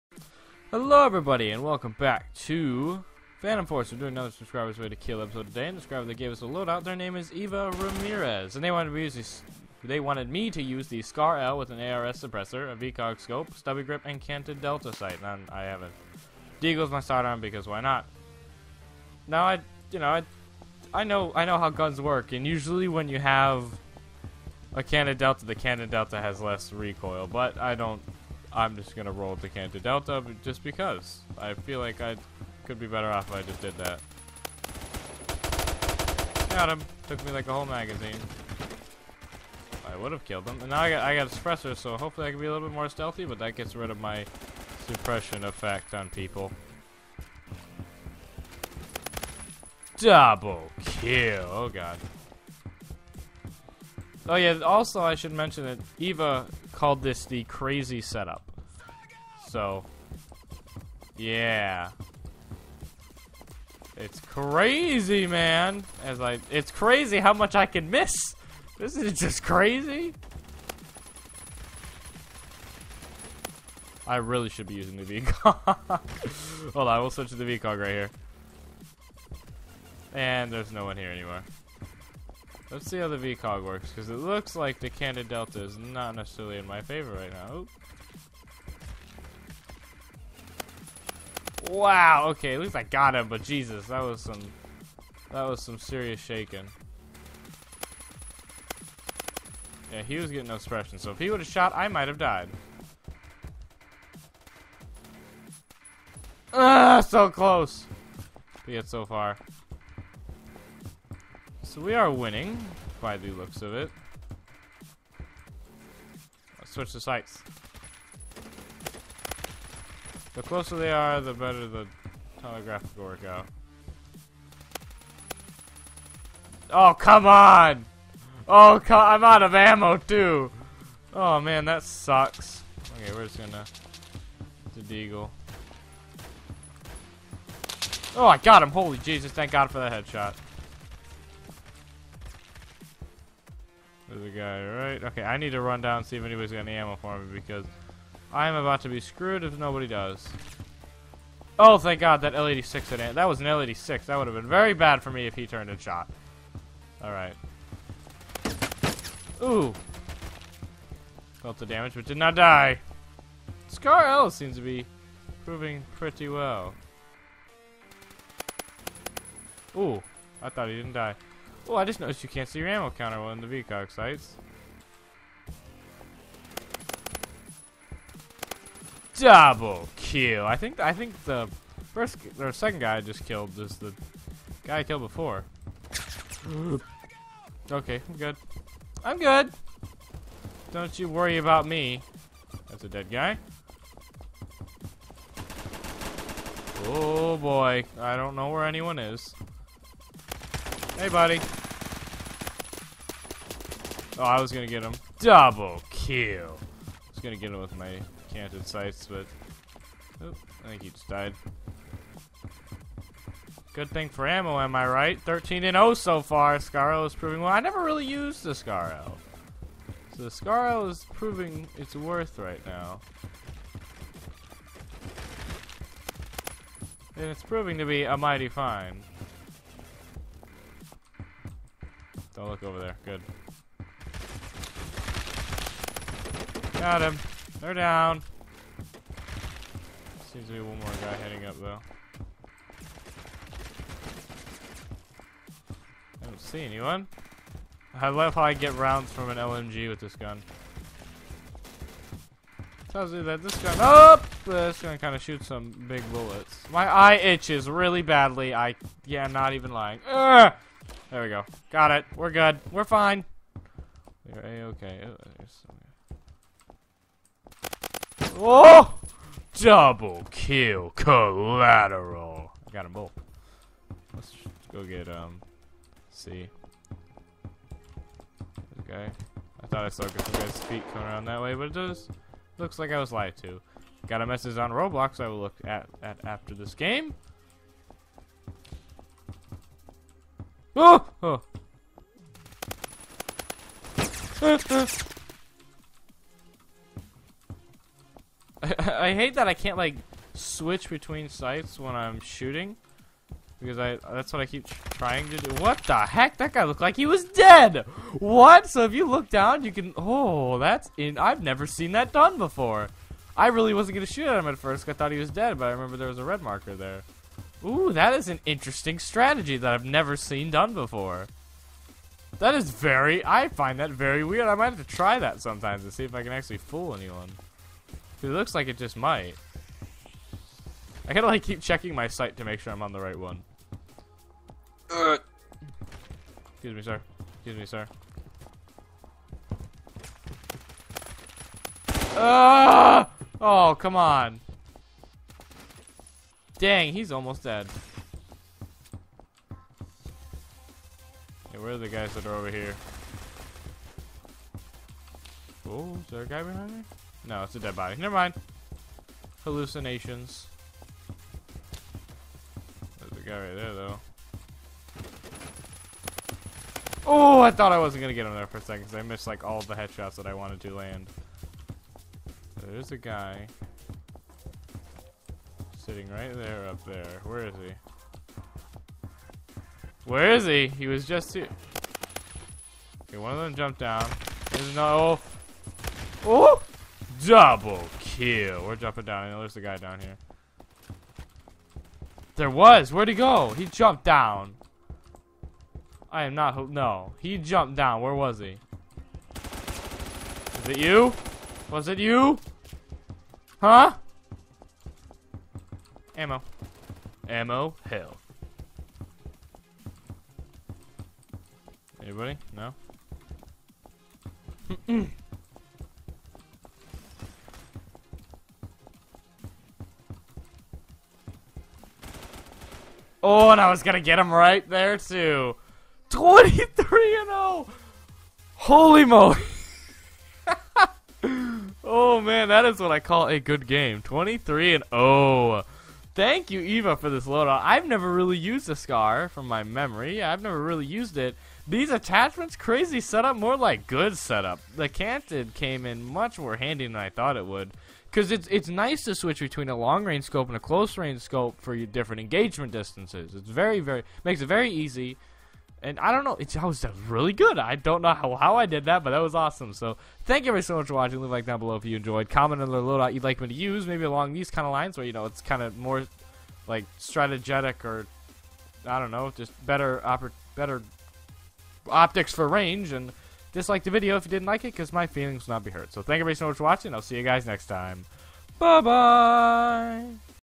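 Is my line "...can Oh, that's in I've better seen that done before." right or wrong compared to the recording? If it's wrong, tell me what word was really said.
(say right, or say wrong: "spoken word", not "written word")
wrong: "never", not "better".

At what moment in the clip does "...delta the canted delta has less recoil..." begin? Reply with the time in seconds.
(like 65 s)
25 s.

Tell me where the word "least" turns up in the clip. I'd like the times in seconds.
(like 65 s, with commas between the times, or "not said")
92 s.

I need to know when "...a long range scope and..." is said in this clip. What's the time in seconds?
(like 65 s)
449 s.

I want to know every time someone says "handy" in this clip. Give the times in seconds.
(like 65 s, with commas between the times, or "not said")
446 s.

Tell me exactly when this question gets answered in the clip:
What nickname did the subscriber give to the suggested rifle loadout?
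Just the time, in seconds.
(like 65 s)
57 s.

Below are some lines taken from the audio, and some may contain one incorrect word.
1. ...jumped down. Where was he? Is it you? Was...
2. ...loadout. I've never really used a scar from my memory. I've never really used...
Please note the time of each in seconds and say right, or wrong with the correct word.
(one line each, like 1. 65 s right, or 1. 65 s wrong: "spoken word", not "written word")
1. 397 s right
2. 437 s right.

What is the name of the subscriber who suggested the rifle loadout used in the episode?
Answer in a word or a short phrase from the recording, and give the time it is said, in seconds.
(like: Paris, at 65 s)
Eva Ramirez, at 7 s.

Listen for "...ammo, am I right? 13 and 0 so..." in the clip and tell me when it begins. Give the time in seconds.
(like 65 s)
214 s.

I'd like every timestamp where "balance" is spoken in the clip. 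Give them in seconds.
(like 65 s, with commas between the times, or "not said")
not said.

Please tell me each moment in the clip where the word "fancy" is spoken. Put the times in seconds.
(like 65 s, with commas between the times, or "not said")
not said.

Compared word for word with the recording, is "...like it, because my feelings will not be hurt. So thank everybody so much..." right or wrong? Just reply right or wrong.
right.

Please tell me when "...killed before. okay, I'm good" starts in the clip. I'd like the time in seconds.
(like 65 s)
184 s.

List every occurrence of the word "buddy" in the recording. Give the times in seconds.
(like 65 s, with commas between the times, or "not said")
201 s.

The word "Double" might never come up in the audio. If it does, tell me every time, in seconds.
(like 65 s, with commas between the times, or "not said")
49 s, 179 s, 205 s, 269 s, 387 s.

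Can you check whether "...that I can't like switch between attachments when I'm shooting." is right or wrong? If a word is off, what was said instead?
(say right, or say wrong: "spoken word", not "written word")
wrong: "sights", not "attachments".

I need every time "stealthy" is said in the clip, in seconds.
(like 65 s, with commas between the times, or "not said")
42 s.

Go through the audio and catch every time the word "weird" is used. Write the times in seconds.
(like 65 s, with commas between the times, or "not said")
324 s.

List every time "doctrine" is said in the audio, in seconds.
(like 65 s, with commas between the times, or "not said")
not said.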